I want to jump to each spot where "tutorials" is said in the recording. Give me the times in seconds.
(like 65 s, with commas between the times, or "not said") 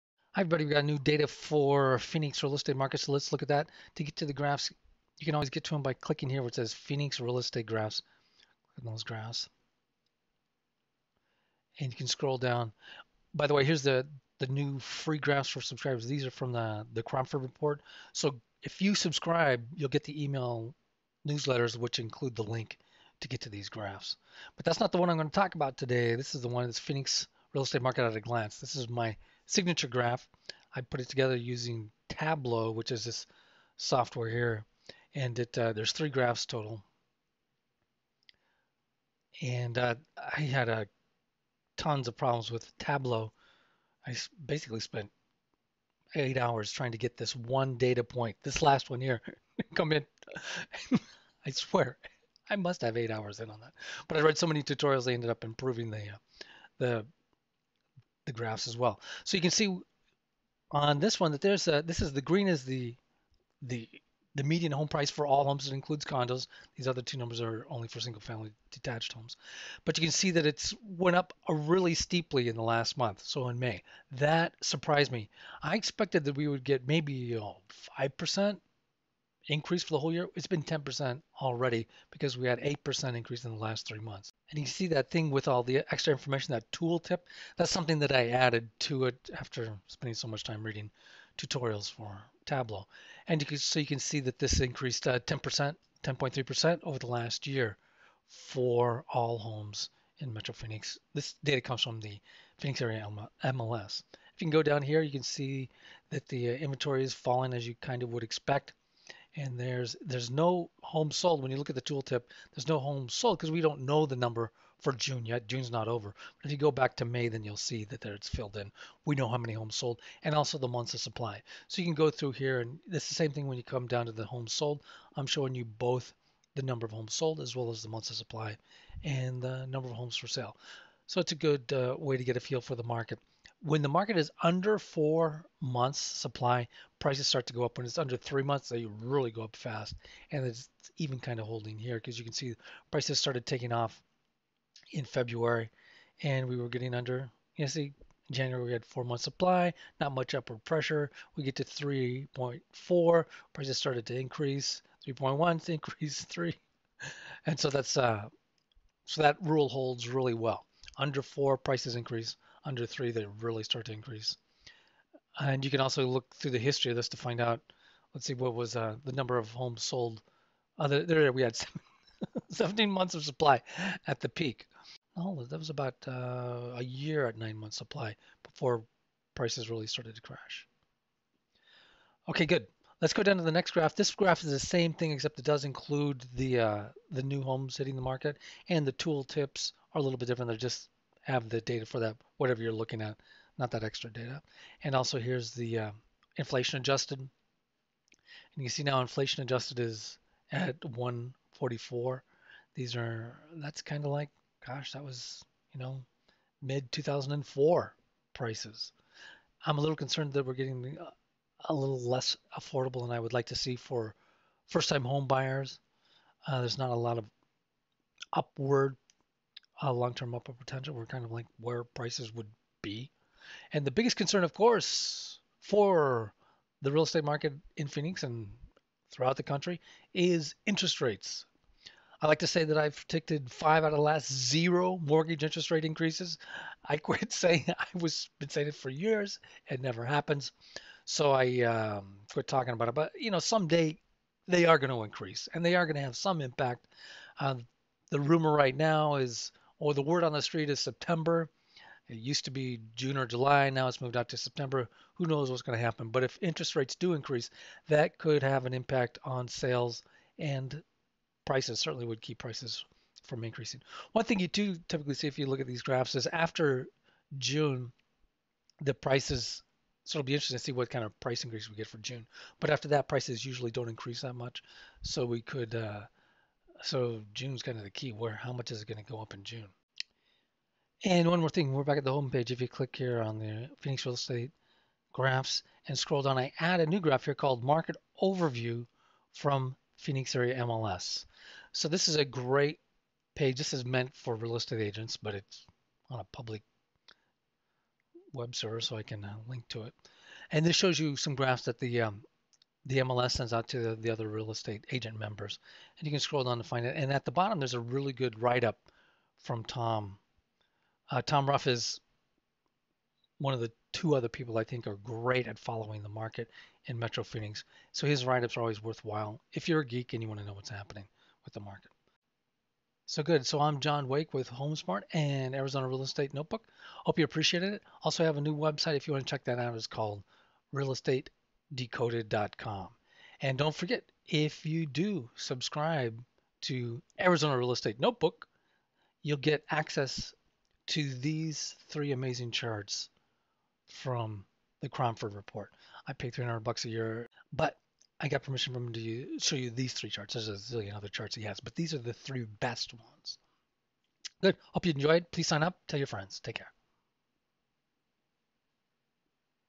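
54 s, 91 s.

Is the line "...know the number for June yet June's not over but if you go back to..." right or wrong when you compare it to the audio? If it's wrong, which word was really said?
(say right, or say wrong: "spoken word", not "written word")
right.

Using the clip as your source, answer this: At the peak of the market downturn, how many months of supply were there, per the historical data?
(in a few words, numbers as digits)
17.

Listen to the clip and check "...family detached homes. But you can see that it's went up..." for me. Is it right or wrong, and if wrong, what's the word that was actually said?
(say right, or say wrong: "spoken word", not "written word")
right.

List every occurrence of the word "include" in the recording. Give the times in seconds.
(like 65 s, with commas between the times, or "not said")
21 s, 65 s, 185 s.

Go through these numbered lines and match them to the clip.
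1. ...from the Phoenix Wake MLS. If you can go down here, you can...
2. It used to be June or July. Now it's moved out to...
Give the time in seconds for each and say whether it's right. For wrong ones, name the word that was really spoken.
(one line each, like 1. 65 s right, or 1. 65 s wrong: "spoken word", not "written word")
1. 101 s wrong: "Area", not "Wake"
2. 252 s right.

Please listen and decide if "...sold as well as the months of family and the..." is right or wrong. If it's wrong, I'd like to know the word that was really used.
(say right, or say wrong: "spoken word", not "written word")
wrong: "supply", not "family".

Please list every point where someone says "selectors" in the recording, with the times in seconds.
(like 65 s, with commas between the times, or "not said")
not said.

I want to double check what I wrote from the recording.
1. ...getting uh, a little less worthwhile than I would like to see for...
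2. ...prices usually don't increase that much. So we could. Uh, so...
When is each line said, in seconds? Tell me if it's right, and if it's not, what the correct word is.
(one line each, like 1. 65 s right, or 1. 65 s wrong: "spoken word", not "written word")
1. 210 s wrong: "affordable", not "worthwhile"
2. 273 s right.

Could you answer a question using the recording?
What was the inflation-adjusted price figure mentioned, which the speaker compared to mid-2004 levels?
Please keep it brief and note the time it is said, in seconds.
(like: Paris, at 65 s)
144, at 200 s.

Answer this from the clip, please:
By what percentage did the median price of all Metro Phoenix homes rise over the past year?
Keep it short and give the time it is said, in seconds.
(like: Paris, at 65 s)
10.3%, at 96 s.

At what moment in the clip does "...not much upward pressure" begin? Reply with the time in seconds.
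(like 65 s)
149 s.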